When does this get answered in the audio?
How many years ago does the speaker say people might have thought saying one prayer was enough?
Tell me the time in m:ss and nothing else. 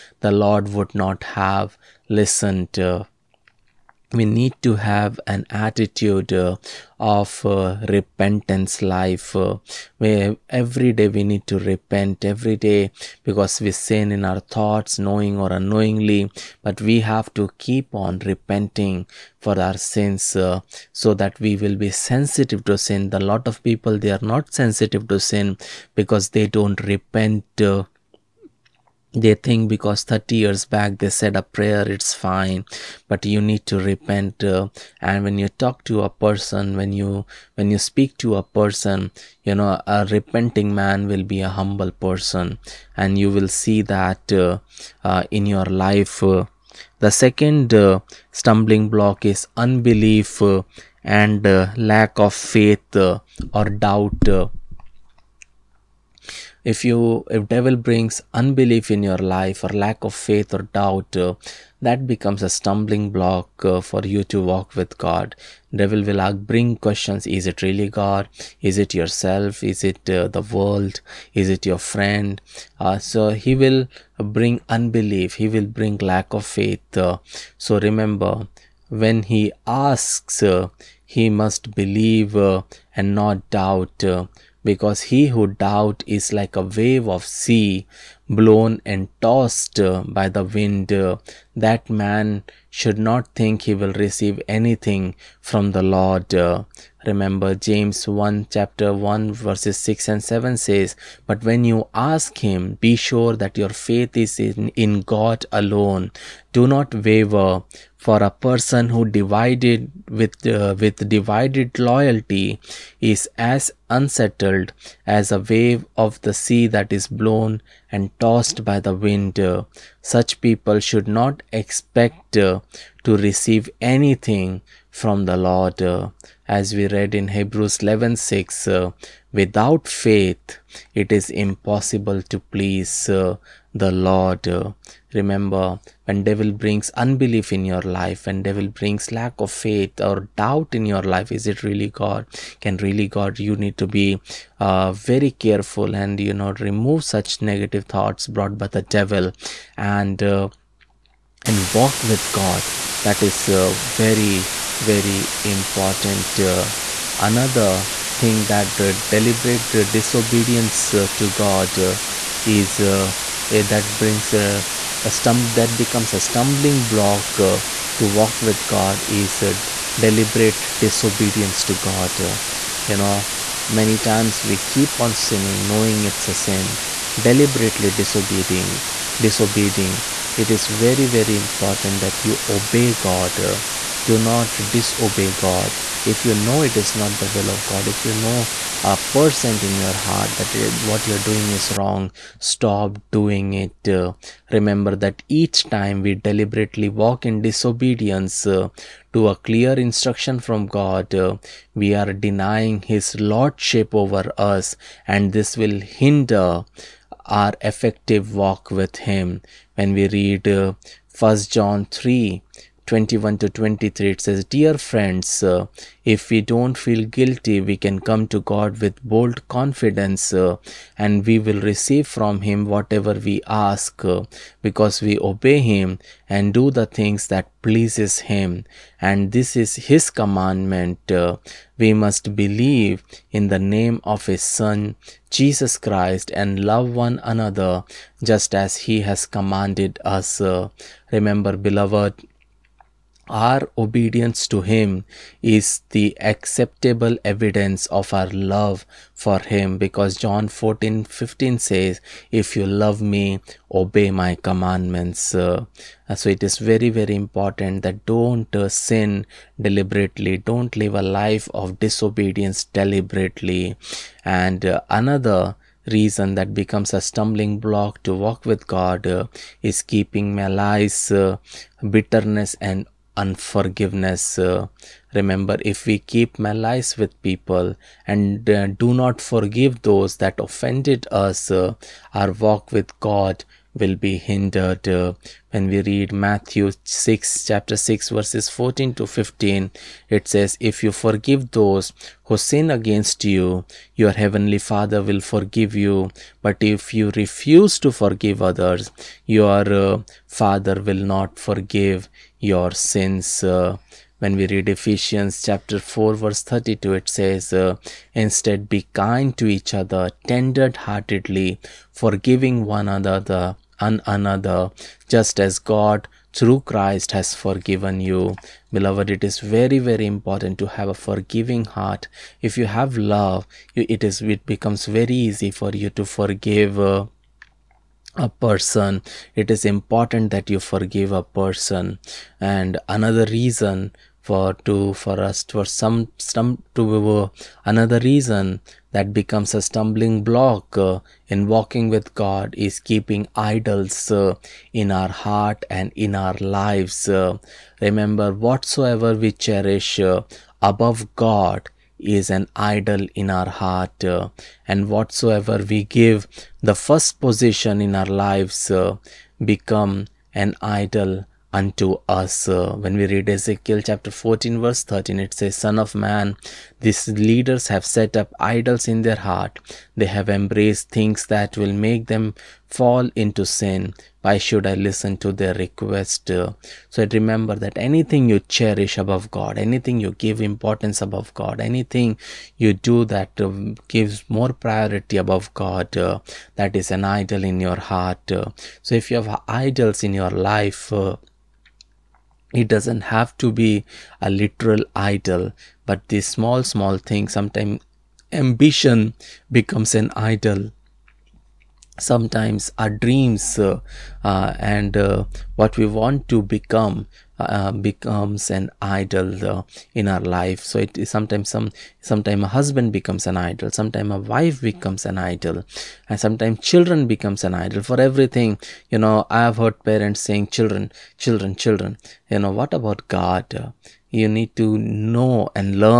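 0:30.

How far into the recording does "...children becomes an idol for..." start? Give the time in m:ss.
6:56.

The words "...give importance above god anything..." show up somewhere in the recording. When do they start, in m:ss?
6:20.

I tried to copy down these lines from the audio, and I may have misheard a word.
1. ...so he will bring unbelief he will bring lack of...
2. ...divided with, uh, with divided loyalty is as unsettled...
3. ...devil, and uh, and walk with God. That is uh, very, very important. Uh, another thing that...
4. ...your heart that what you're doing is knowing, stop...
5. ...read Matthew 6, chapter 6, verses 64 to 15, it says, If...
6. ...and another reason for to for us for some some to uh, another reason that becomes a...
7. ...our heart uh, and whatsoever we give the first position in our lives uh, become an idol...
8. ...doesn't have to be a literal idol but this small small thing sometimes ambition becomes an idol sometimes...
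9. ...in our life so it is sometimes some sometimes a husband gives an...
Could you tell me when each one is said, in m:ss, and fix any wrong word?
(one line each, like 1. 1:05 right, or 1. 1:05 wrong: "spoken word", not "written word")
1. 1:12 right
2. 1:49 right
3. 2:28 right
4. 3:09 wrong: "wrong", not "knowing"
5. 4:45 wrong: "14", not "64"
6. 5:32 right
7. 5:53 right
8. 6:32 right
9. 6:49 wrong: "becomes", not "gives".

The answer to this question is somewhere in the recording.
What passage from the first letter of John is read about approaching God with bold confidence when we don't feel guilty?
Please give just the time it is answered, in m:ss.
3:30.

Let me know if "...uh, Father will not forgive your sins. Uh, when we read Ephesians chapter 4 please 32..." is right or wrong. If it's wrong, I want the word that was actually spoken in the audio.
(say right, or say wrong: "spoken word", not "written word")
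wrong: "verse", not "please".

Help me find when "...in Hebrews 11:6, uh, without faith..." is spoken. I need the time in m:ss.
2:07.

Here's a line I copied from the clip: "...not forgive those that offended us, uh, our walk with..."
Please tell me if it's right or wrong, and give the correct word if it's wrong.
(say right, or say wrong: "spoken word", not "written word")
right.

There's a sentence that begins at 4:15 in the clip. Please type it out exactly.
Uh, so it is very, very important that don't uh, sin deliberately, don't live a life of disobedience deliberately.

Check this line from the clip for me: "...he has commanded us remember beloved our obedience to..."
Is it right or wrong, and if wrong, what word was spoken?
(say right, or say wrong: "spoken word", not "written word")
right.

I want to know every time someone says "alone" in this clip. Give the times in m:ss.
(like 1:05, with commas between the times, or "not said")
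1:45.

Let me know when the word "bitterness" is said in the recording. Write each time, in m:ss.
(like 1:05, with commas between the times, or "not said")
4:31.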